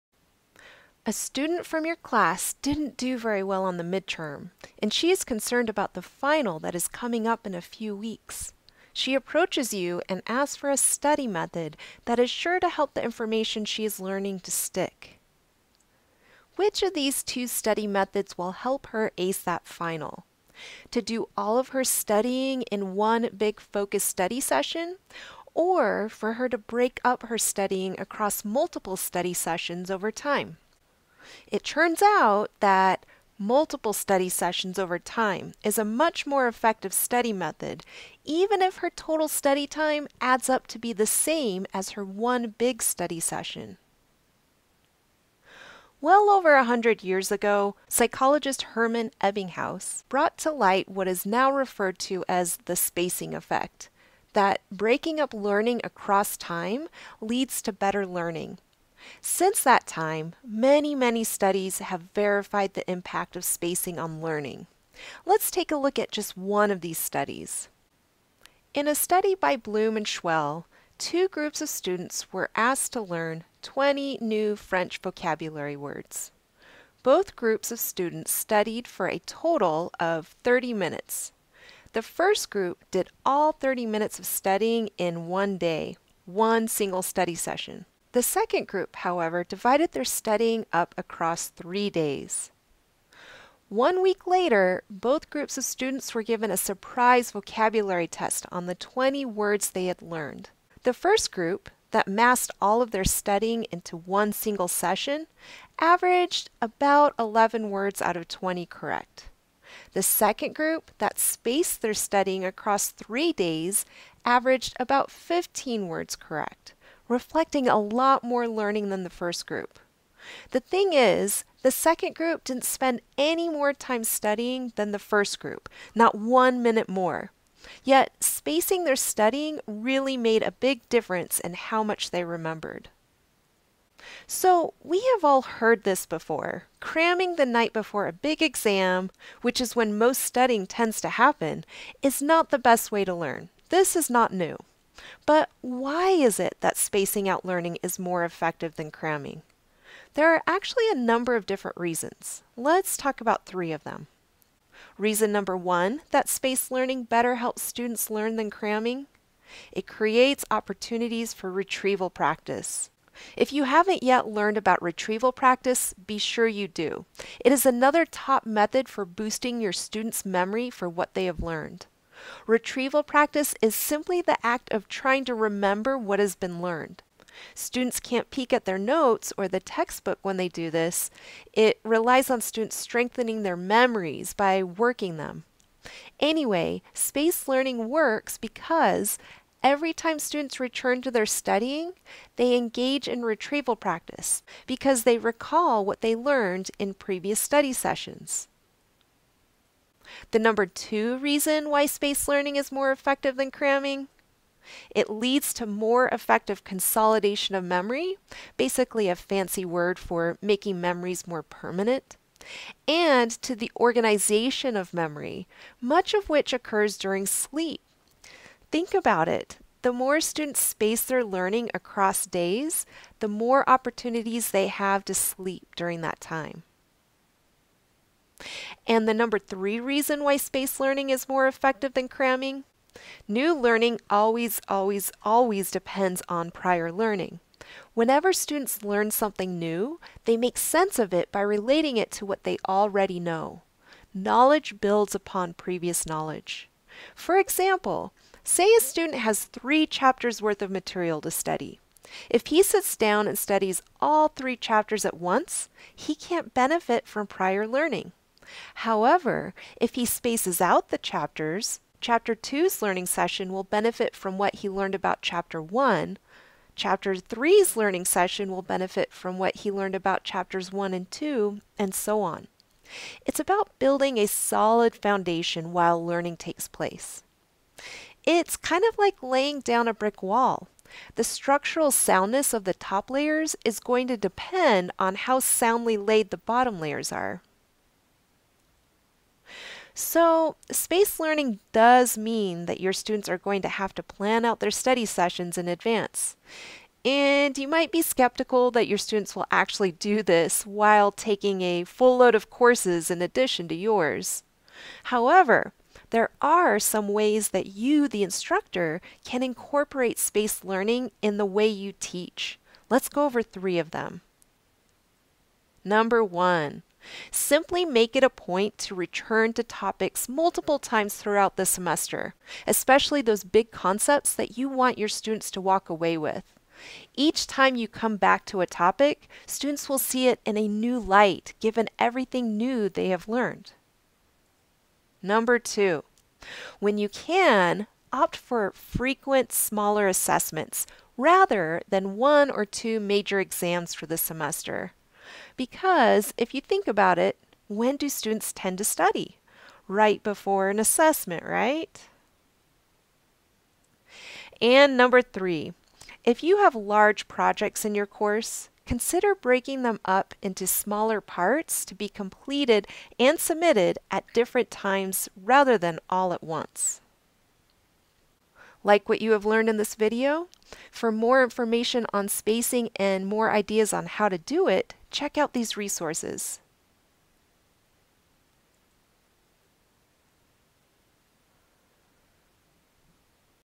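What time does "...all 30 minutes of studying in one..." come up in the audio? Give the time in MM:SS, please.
01:23.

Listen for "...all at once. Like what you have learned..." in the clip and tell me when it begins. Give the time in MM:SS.
06:06.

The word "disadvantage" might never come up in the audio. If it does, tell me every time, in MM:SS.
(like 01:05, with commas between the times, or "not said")
not said.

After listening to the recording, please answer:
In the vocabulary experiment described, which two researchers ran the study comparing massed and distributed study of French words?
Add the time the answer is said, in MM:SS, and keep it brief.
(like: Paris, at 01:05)
Bloom and Shuell, at 01:09.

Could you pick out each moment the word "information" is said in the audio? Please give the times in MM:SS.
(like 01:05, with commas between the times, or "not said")
00:13, 06:11.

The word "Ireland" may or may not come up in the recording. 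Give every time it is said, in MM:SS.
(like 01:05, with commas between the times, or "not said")
not said.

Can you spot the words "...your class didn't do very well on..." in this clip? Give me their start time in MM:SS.
00:01.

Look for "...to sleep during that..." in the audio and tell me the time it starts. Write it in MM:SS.
03:45.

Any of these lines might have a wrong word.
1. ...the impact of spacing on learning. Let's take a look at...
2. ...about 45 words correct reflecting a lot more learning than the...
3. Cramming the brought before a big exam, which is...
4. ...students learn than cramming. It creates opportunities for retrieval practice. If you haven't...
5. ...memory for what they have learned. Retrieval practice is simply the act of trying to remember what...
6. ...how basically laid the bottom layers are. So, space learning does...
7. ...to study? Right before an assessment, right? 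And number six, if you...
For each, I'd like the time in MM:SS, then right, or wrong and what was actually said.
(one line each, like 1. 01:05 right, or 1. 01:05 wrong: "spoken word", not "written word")
1. 01:02 right
2. 01:54 wrong: "15", not "45"
3. 02:16 wrong: "night", not "brought"
4. 02:37 right
5. 02:50 right
6. 04:45 wrong: "soundly", not "basically"
7. 05:48 wrong: "three", not "six".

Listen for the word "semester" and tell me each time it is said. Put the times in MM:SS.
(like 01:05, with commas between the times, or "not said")
05:21, 05:44.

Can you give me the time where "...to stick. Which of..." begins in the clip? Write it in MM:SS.
00:14.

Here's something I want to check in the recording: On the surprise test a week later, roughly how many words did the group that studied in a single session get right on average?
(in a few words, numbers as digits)
11.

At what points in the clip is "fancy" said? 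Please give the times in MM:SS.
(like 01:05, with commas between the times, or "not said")
03:29.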